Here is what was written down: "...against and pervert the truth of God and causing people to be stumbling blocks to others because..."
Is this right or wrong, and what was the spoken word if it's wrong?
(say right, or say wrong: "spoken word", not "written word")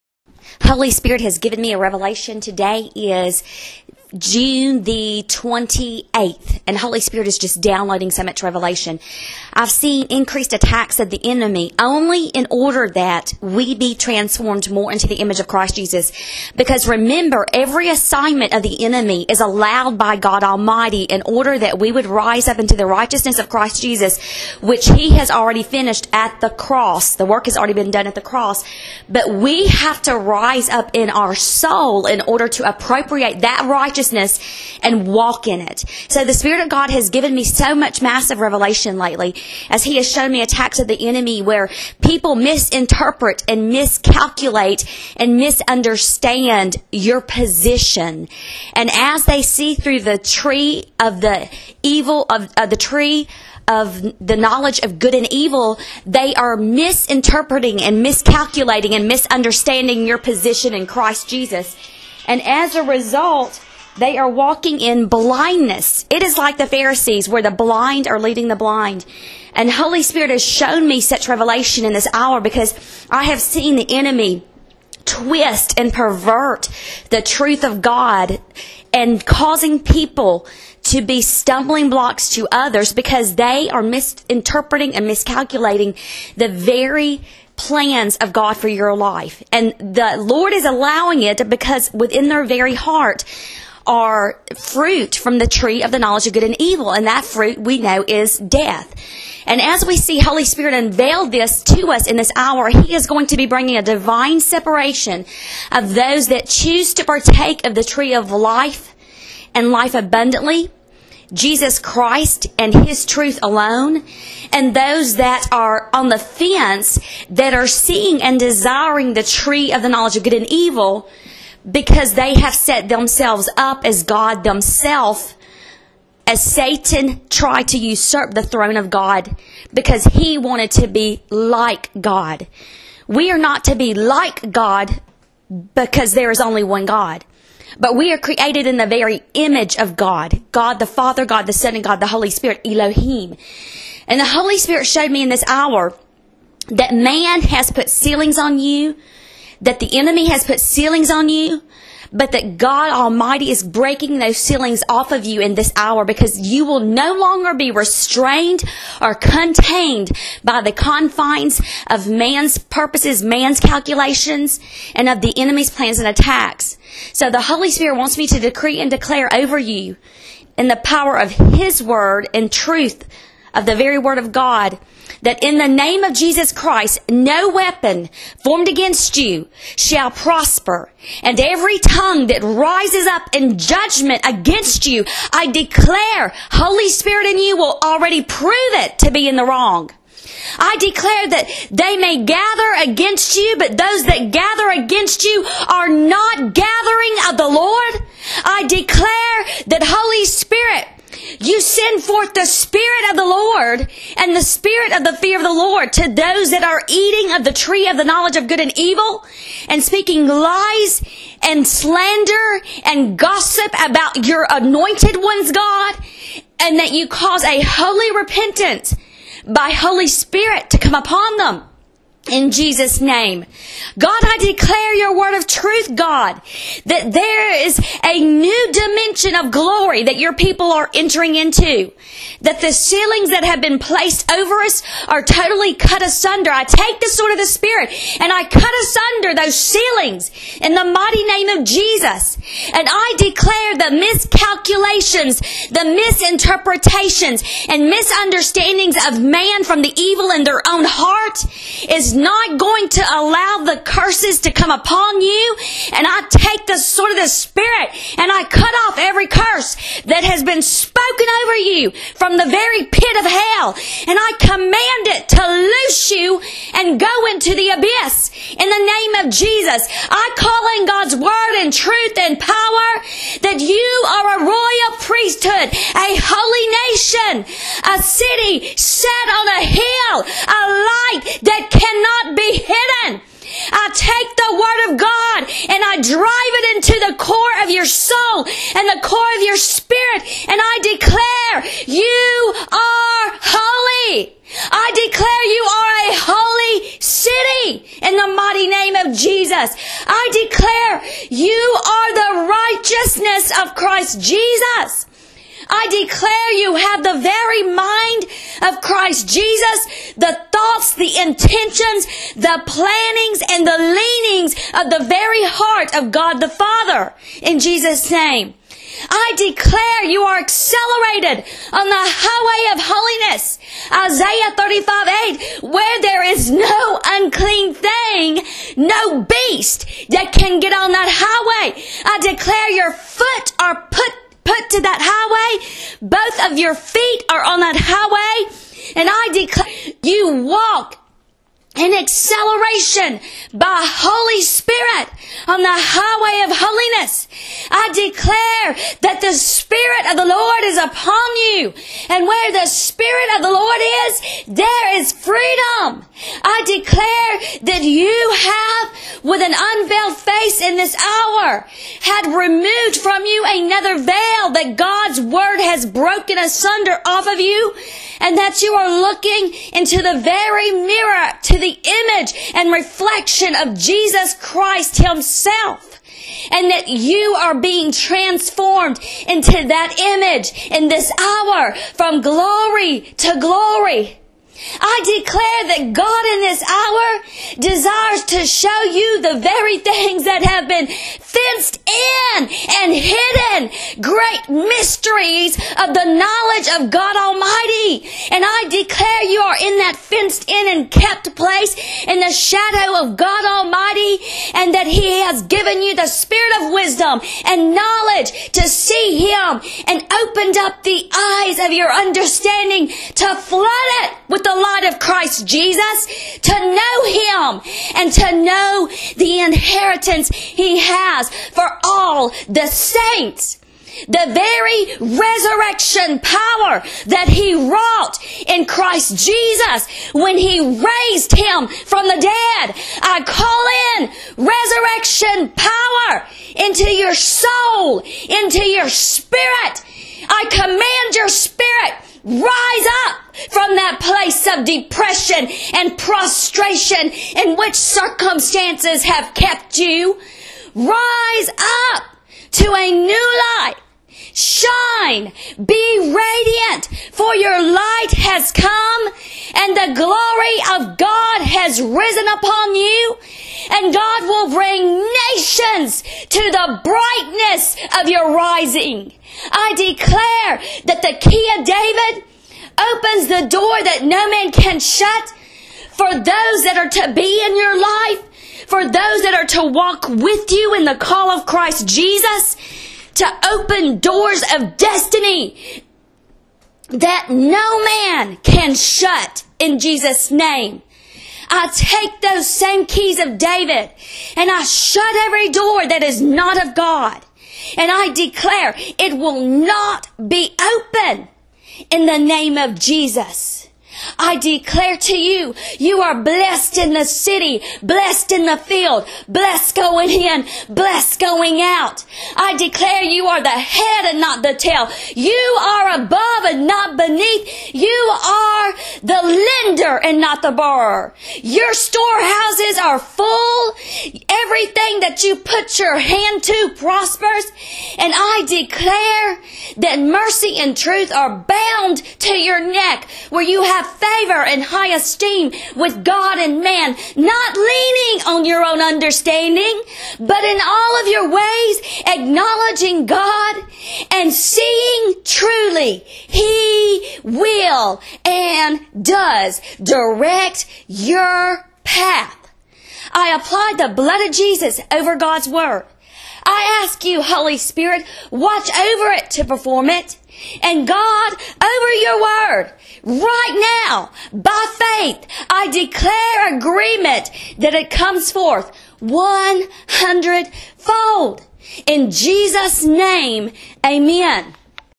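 wrong: "twist", not "against".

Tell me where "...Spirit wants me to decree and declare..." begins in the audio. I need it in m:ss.
2:47.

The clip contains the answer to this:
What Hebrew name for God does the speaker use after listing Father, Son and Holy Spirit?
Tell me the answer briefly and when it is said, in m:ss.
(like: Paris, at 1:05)
Elohim, at 2:22.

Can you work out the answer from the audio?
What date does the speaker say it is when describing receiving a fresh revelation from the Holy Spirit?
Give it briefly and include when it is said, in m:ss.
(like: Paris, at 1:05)
June 28, at 0:04.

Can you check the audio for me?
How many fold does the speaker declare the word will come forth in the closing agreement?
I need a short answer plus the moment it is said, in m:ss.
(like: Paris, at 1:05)
100 fold, at 9:28.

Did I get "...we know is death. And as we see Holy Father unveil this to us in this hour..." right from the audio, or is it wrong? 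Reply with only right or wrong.
wrong.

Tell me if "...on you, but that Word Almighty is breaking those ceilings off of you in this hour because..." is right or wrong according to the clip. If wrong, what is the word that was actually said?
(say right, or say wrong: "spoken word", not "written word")
wrong: "God", not "Word".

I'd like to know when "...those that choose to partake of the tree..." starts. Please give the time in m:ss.
1:45.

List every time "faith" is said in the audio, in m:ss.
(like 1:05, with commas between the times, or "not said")
9:24.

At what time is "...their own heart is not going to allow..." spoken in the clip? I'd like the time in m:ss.
4:10.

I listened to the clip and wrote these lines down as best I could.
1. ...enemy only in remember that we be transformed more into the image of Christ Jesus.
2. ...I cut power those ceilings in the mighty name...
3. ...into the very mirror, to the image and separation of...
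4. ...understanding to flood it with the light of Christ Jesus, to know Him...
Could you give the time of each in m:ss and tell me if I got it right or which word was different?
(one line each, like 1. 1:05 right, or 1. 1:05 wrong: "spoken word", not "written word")
1. 0:11 wrong: "order", not "remember"
2. 3:58 wrong: "asunder", not "power"
3. 6:09 wrong: "reflection", not "separation"
4. 6:51 right.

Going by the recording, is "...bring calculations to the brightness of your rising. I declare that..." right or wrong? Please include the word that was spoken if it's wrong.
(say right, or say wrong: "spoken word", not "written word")
wrong: "nations", not "calculations".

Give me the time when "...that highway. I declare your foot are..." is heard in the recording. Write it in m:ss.
5:30.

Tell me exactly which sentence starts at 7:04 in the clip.
The very resurrection power that He wrought in Christ Jesus when He raised Him from the dead.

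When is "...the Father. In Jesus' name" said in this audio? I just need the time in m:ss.
5:16.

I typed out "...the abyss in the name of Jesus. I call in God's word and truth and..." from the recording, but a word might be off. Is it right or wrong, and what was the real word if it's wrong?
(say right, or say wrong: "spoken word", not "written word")
right.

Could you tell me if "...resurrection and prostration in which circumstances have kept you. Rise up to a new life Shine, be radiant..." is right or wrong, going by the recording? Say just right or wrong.
wrong.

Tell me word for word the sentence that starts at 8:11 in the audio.
I take those same keys of David and I shut every door that is not of God.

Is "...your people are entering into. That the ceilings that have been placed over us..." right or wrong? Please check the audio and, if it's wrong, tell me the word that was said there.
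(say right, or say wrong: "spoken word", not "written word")
right.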